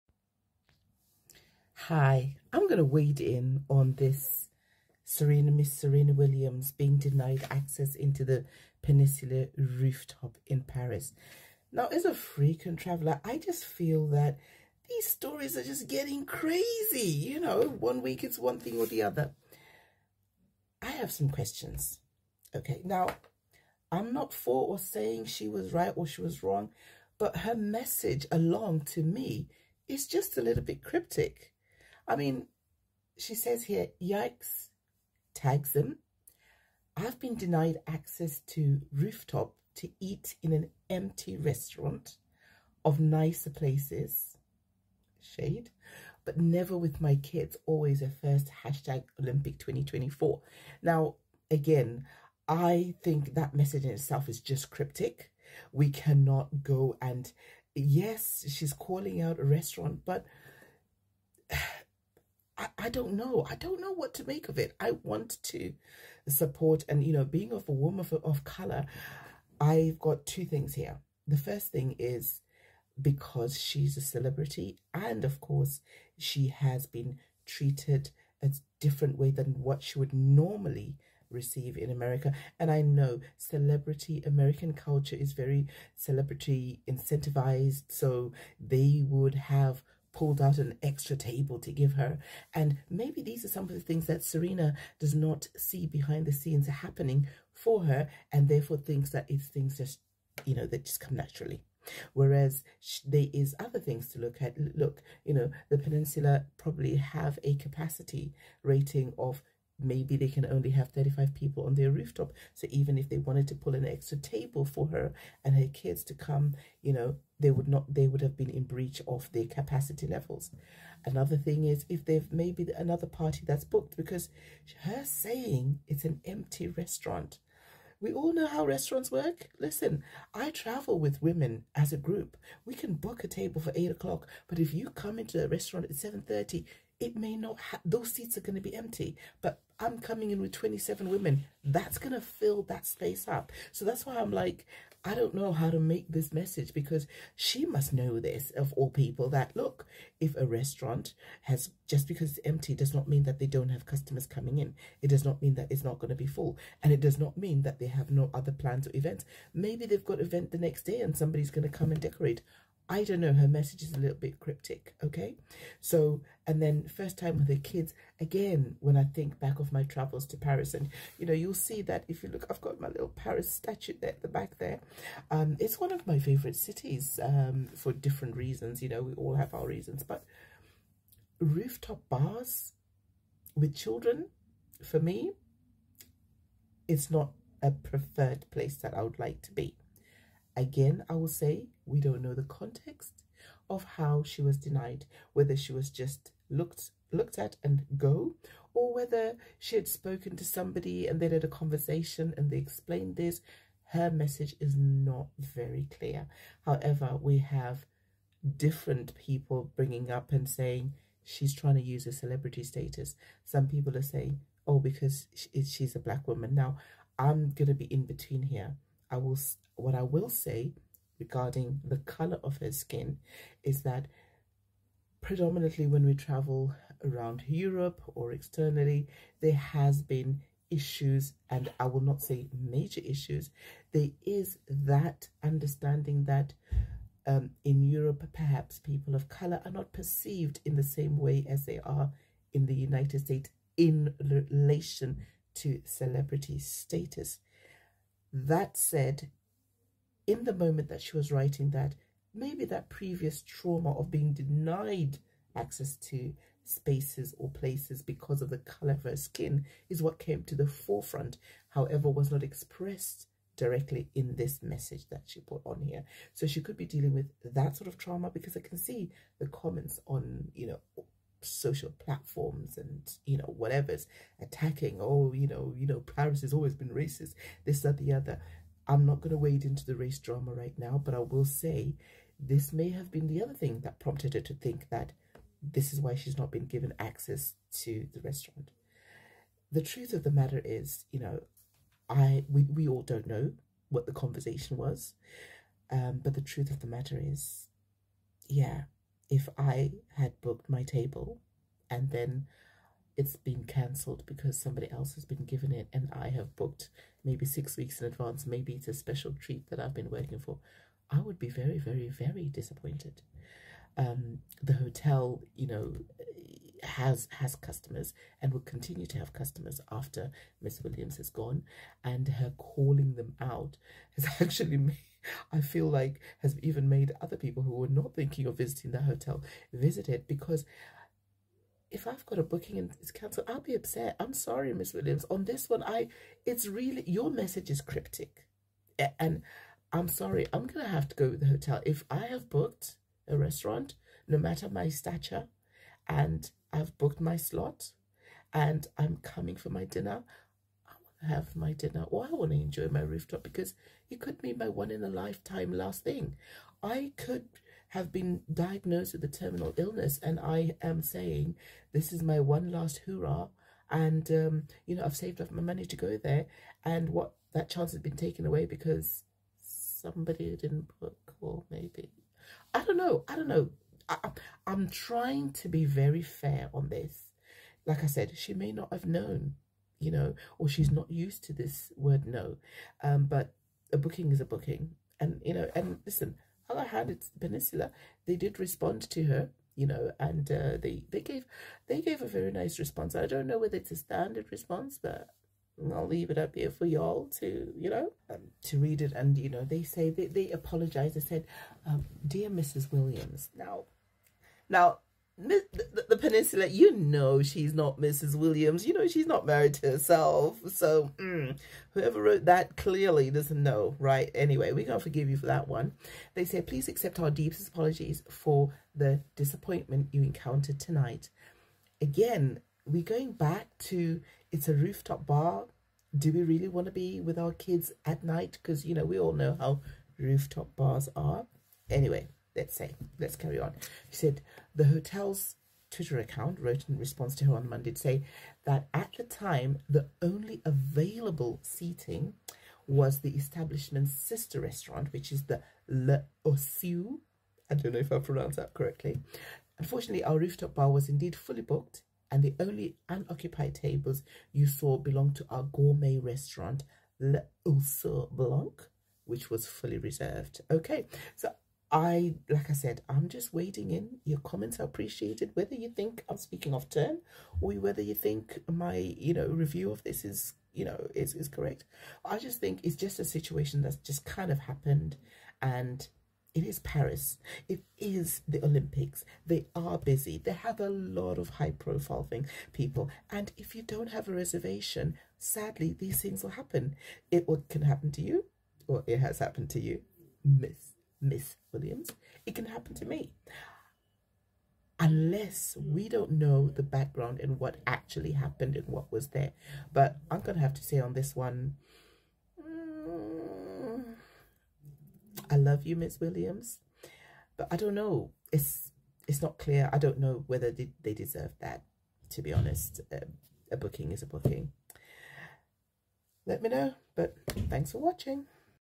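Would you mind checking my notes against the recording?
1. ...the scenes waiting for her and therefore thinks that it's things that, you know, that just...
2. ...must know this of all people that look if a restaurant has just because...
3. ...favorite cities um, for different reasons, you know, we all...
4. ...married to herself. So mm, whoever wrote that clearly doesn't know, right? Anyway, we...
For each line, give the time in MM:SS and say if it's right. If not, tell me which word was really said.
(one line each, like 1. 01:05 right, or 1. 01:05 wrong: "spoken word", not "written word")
1. 01:36 wrong: "happening", not "waiting"
2. 02:27 right
3. 02:56 right
4. 06:49 right.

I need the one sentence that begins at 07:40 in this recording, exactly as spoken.
Okay, so I, like I said, I'm just waiting in.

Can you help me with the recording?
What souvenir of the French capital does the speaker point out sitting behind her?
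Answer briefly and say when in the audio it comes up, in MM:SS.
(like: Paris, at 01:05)
Paris statue, at 02:52.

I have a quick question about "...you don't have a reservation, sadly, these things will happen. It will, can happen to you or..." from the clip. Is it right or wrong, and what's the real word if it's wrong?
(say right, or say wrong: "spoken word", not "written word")
right.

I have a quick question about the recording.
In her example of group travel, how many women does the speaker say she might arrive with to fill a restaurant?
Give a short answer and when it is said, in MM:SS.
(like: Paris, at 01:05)
27, at 02:20.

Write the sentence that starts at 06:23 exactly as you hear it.
Um, but a booking is a booking.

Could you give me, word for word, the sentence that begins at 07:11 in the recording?
Anyway, let's say, let's carry on.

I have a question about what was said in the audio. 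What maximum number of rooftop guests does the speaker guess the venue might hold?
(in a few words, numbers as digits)
35.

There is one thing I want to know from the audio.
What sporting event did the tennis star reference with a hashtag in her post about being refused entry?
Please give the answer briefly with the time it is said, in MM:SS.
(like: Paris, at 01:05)
Olympic 2024, at 00:49.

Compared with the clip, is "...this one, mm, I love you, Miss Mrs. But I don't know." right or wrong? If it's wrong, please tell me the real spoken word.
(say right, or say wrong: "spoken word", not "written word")
wrong: "Williams", not "Mrs".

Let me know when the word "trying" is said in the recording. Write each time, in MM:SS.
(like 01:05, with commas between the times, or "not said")
03:31, 06:14.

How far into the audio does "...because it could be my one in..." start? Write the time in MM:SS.
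05:53.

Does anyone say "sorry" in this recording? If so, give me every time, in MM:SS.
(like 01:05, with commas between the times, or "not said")
05:34, 05:40.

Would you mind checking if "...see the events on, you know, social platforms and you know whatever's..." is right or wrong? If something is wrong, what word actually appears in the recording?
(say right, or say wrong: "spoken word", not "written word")
wrong: "comments", not "events".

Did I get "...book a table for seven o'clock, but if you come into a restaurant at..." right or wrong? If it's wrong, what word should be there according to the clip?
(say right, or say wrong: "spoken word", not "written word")
wrong: "eight", not "seven".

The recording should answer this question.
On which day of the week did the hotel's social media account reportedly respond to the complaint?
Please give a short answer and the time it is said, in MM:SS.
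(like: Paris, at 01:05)
Monday, at 07:17.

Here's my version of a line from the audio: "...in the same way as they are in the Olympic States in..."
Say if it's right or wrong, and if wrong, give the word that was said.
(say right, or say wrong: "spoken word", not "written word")
wrong: "United", not "Olympic".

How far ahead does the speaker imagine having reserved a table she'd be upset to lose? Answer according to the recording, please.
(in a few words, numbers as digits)
Six weeks.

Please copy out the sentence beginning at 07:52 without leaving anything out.
I just think it's just a situation that's just kind of happened and it is Paris.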